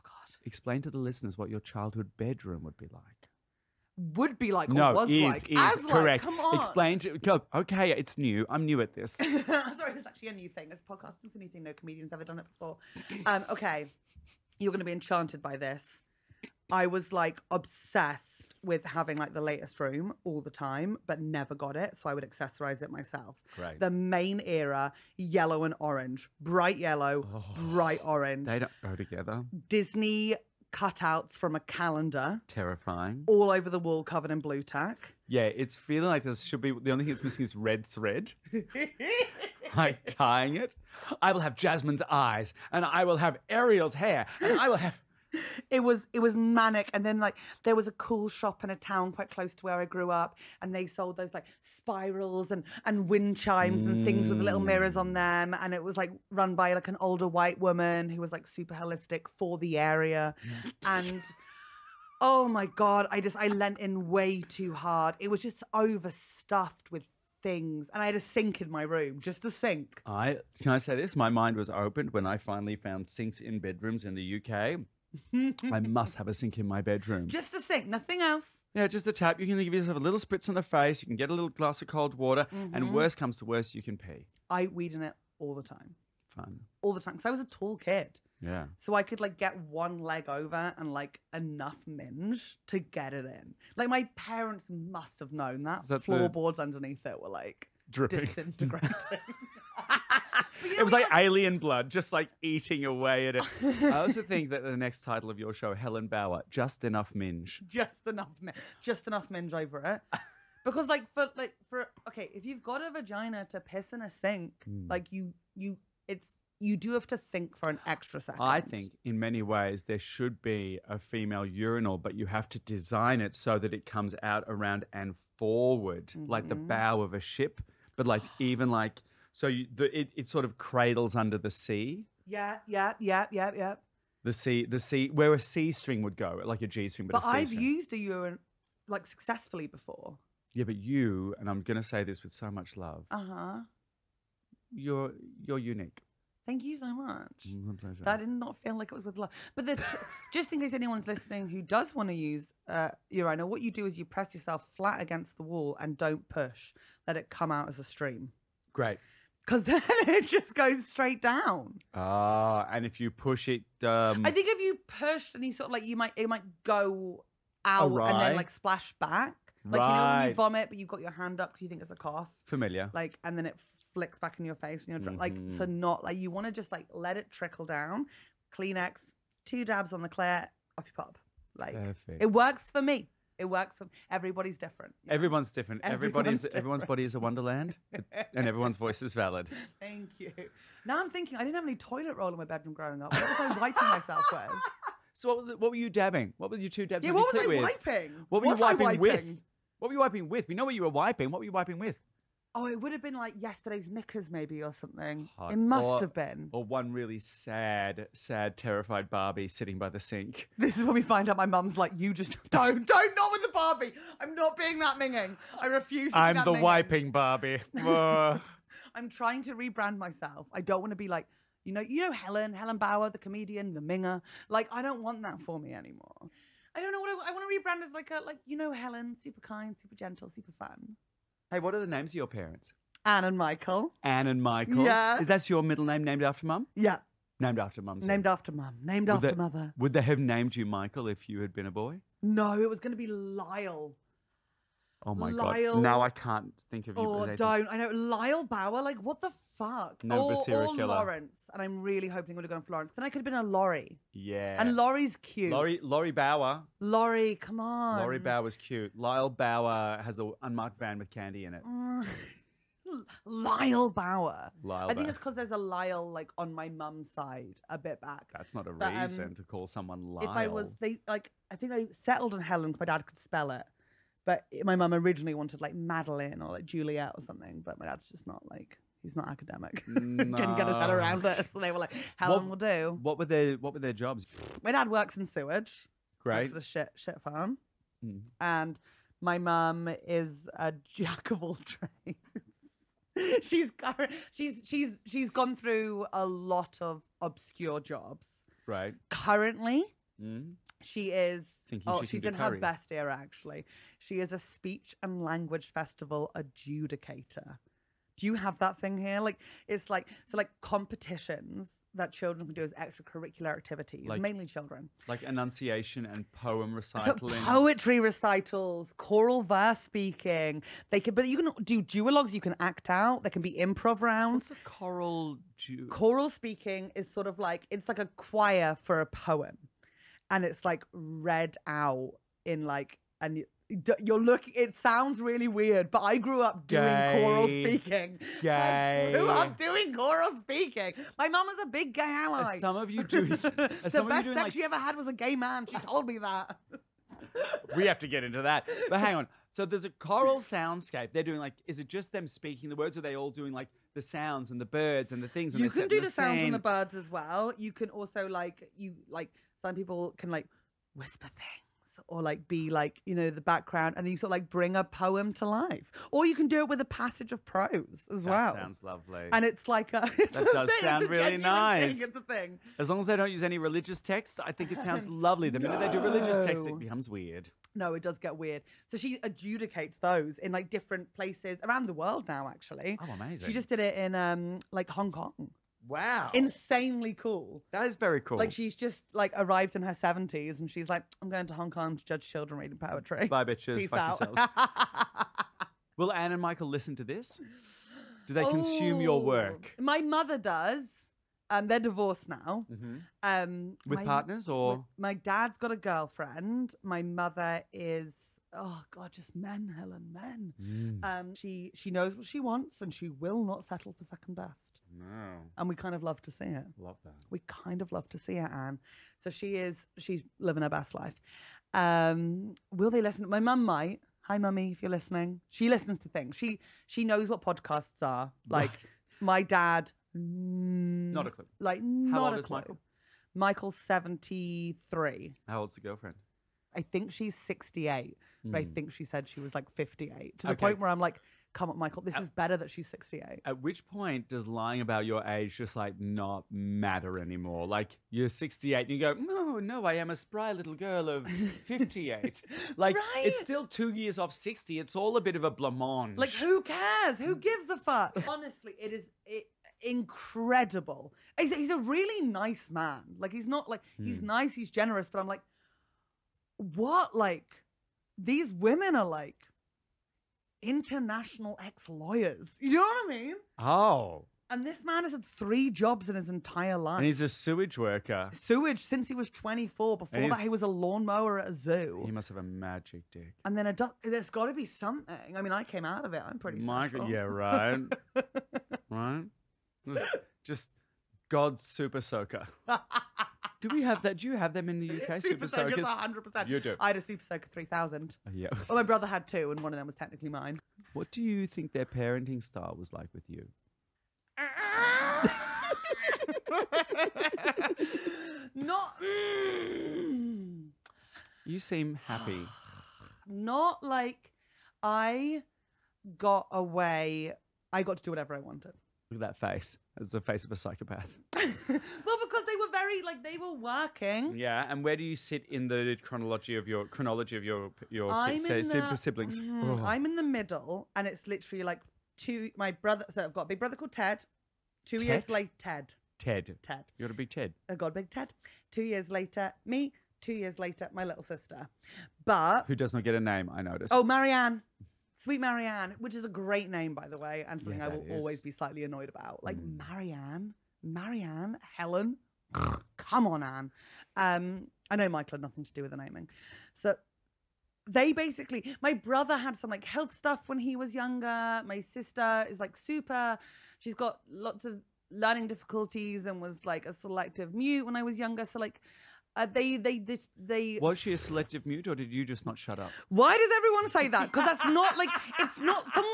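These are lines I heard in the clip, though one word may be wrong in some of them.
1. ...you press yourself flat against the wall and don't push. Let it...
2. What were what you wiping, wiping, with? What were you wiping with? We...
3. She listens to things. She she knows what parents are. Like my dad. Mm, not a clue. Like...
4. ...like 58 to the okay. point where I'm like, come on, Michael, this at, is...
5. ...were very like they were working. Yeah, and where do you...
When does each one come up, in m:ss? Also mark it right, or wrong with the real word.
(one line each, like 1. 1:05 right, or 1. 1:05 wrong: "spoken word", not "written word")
1. 2:33 right
2. 3:18 right
3. 7:05 wrong: "podcasts", not "parents"
4. 7:19 right
5. 8:42 right.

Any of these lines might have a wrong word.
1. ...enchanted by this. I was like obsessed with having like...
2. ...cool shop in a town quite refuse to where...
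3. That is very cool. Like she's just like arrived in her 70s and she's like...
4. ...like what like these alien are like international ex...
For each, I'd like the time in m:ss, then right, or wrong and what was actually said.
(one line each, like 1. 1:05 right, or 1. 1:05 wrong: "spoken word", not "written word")
1. 0:14 right
2. 0:47 wrong: "close", not "refuse"
3. 6:27 right
4. 7:45 wrong: "women", not "alien".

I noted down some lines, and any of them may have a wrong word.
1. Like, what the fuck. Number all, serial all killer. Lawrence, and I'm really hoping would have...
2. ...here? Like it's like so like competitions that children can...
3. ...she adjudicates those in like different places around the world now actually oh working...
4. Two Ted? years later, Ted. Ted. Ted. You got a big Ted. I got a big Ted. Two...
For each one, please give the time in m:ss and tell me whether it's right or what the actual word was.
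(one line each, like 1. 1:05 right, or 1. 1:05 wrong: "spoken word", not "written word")
1. 4:08 right
2. 5:08 right
3. 6:18 wrong: "amazing", not "working"
4. 8:54 right.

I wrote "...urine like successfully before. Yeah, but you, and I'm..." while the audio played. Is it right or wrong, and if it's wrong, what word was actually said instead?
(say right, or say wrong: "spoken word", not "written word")
right.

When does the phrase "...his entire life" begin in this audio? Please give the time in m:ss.
7:56.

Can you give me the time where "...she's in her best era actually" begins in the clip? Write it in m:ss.
5:02.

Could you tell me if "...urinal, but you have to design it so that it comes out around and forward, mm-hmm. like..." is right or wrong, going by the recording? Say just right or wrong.
right.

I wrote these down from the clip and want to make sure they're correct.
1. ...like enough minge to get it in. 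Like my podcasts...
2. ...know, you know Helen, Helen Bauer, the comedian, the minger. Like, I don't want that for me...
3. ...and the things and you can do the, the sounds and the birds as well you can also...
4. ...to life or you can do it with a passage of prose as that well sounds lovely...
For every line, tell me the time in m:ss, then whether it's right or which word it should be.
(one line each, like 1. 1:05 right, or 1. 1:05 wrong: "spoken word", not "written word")
1. 1:30 wrong: "parents", not "podcasts"
2. 3:41 right
3. 5:55 right
4. 6:05 right.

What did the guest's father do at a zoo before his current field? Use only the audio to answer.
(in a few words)
lawnmower.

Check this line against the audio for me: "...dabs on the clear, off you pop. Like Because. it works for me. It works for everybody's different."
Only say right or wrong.
wrong.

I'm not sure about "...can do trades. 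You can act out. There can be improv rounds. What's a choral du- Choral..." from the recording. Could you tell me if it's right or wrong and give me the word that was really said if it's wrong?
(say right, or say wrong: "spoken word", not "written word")
wrong: "duologues", not "trades".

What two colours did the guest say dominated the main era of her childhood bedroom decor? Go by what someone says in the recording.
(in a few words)
yellow and orange.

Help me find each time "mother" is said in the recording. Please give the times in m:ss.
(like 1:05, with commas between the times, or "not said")
3:59, 6:39, 6:47.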